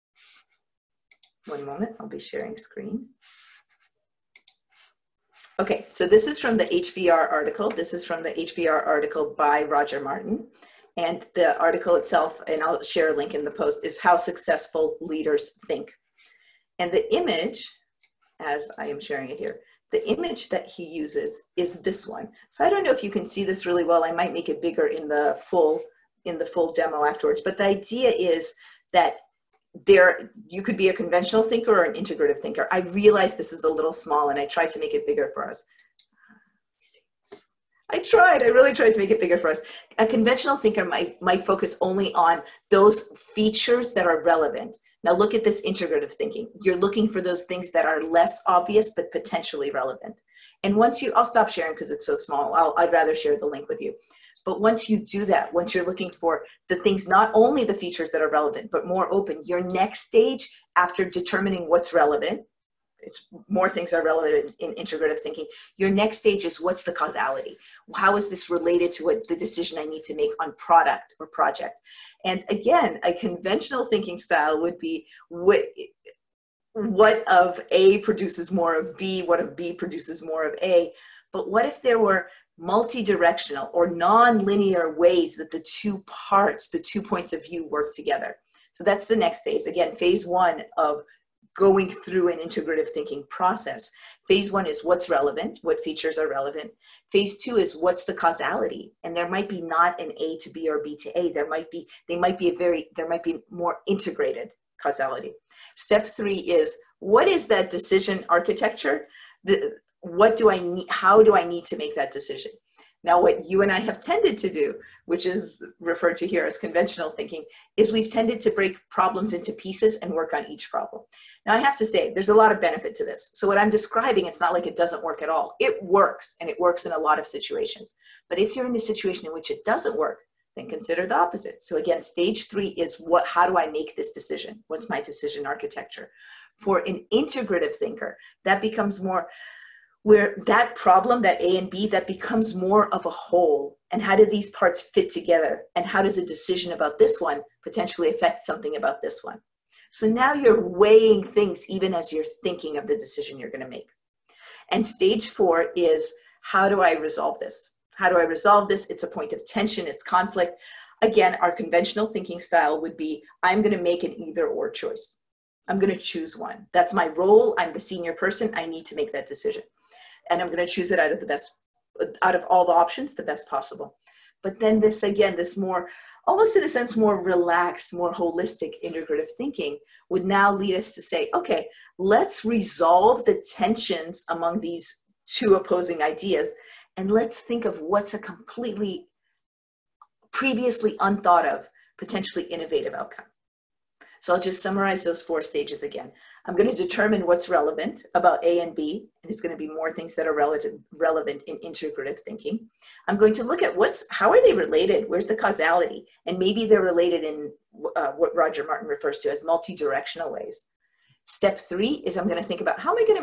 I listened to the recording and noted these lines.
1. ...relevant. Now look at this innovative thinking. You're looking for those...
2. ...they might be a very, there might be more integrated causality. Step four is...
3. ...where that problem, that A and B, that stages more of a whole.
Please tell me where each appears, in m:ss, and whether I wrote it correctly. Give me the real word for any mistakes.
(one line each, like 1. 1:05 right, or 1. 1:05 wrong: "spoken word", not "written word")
1. 0:44 wrong: "integrative", not "innovative"
2. 1:42 wrong: "three", not "four"
3. 2:20 wrong: "becomes", not "stages".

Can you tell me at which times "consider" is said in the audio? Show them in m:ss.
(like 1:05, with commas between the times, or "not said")
2:10.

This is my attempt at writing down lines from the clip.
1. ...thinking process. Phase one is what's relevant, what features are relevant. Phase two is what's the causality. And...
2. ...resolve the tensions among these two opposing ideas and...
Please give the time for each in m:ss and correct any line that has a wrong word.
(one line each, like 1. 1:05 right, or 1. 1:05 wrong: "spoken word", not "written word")
1. 1:32 right
2. 3:02 right.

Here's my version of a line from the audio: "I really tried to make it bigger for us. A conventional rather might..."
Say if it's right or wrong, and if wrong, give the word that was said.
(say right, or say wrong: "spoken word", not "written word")
wrong: "thinker", not "rather".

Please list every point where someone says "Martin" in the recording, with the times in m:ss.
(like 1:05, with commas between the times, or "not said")
0:10, 3:28.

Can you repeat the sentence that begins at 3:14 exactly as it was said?
So I'll just summarize those four stages again.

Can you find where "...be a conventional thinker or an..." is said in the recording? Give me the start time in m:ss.
0:30.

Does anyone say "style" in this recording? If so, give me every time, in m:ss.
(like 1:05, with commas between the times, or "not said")
1:14, 2:42.